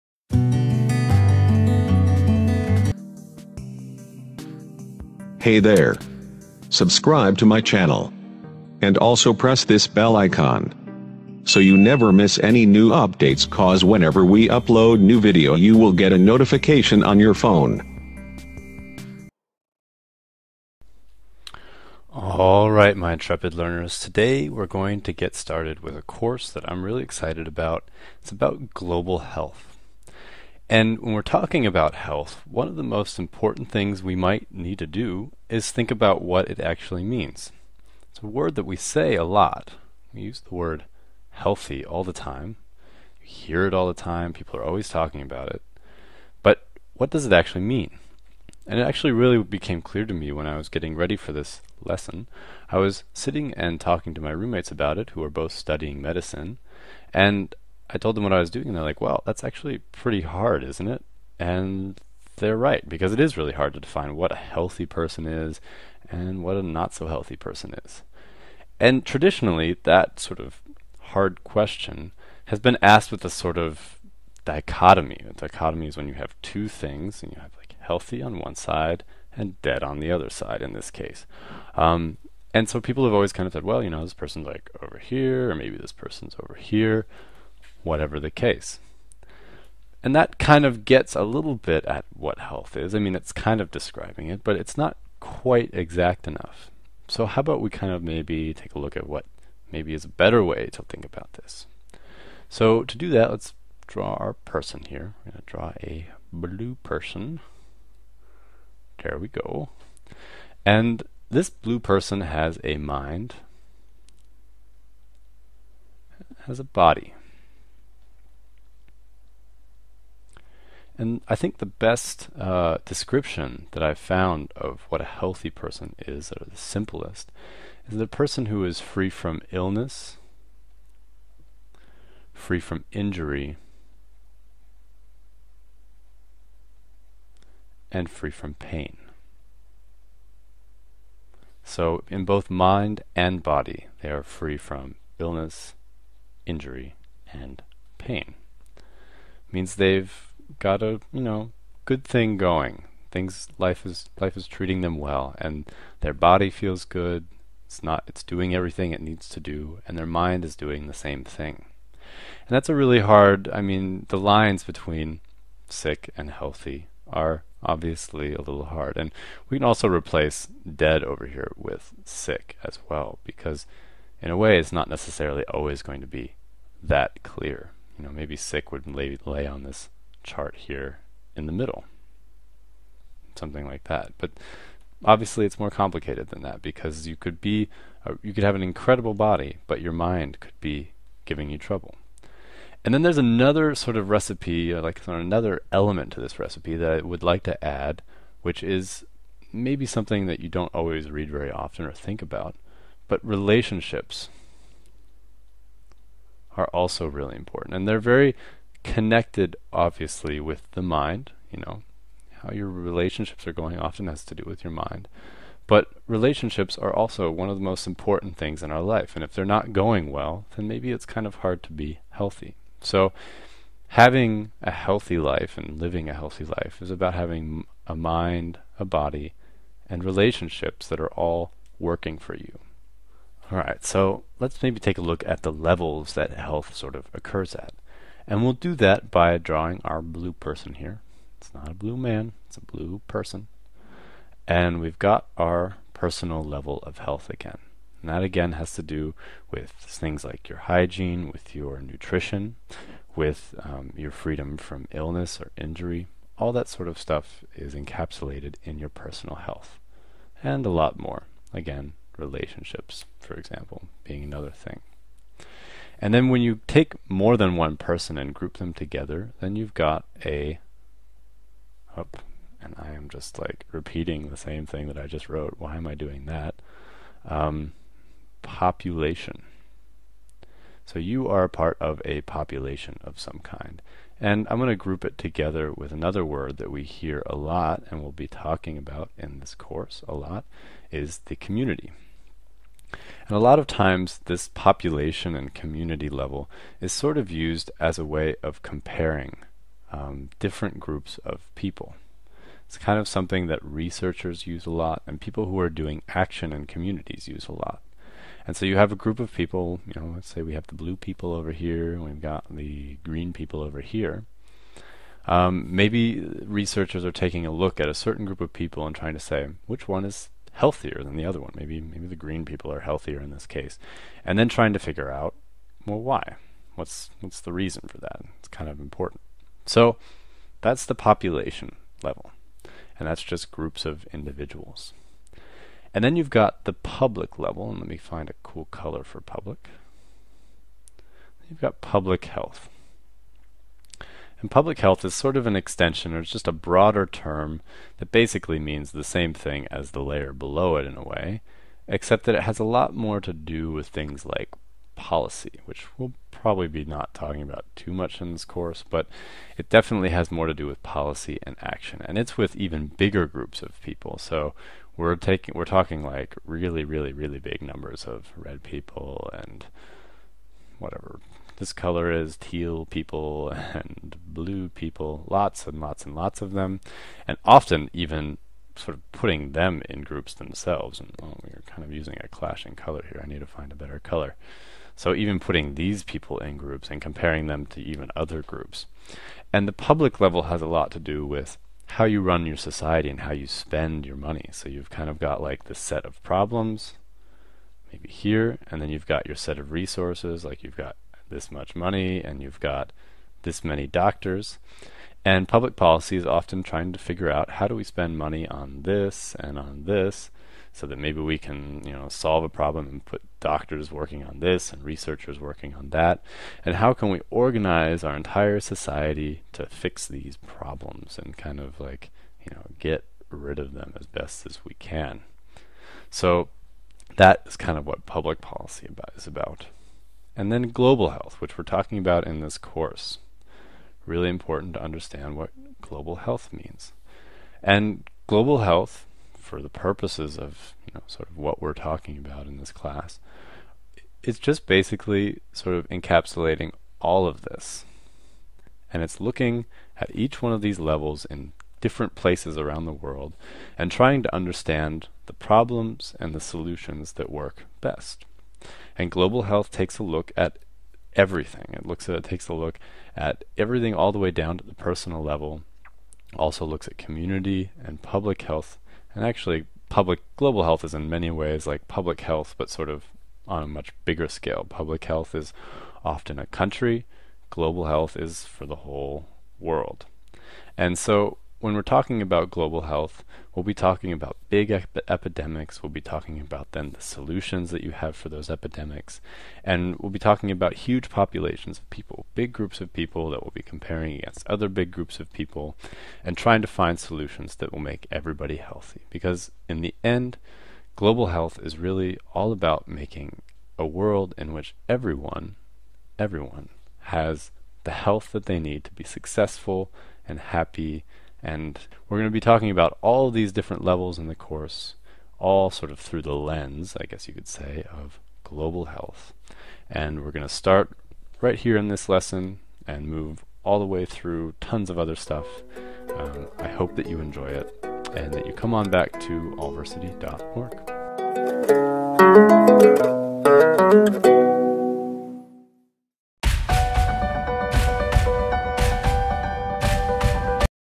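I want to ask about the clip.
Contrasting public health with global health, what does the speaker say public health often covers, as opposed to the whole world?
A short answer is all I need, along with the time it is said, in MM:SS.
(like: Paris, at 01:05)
a country, at 07:56.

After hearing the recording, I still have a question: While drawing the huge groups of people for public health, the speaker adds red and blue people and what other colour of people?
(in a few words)
teal.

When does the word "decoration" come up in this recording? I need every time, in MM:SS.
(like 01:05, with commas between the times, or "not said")
not said.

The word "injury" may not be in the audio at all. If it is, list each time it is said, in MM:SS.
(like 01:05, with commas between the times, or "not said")
02:12, 02:26, 04:15.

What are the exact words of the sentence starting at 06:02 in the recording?
And it's with even bigger groups of people.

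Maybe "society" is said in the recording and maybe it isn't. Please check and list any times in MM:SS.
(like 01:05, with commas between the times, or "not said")
06:32, 06:58.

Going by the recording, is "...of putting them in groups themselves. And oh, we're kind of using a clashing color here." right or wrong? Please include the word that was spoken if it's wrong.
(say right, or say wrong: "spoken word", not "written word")
right.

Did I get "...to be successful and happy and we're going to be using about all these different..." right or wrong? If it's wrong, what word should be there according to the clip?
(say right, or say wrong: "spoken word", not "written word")
wrong: "talking", not "using".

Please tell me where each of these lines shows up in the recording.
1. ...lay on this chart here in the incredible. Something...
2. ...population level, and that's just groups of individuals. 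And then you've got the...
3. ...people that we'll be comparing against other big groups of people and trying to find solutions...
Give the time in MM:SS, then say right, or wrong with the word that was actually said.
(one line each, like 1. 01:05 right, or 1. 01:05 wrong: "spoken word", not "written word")
1. 02:59 wrong: "middle", not "incredible"
2. 05:30 right
3. 08:12 right.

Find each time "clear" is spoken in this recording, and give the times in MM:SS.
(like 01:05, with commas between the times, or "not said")
00:49, 02:57.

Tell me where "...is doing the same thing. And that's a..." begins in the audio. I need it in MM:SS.
02:40.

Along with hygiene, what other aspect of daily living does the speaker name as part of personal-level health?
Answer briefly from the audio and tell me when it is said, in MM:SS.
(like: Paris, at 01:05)
nutrition, at 04:11.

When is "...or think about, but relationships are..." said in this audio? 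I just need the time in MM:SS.
03:21.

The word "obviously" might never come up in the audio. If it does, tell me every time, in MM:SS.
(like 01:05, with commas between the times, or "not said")
02:47, 03:05, 03:29.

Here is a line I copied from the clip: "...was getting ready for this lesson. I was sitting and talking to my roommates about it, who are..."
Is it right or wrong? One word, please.
right.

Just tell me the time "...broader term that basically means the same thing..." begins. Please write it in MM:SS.
05:46.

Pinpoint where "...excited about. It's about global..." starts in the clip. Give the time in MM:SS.
00:27.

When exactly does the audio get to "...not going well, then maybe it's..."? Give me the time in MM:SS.
03:39.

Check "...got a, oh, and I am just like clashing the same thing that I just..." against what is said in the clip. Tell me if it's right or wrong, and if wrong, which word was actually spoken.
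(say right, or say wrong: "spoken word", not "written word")
wrong: "repeating", not "clashing".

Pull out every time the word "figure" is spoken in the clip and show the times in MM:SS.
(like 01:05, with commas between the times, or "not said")
05:24, 06:46.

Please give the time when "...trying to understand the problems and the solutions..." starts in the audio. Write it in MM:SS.
07:33.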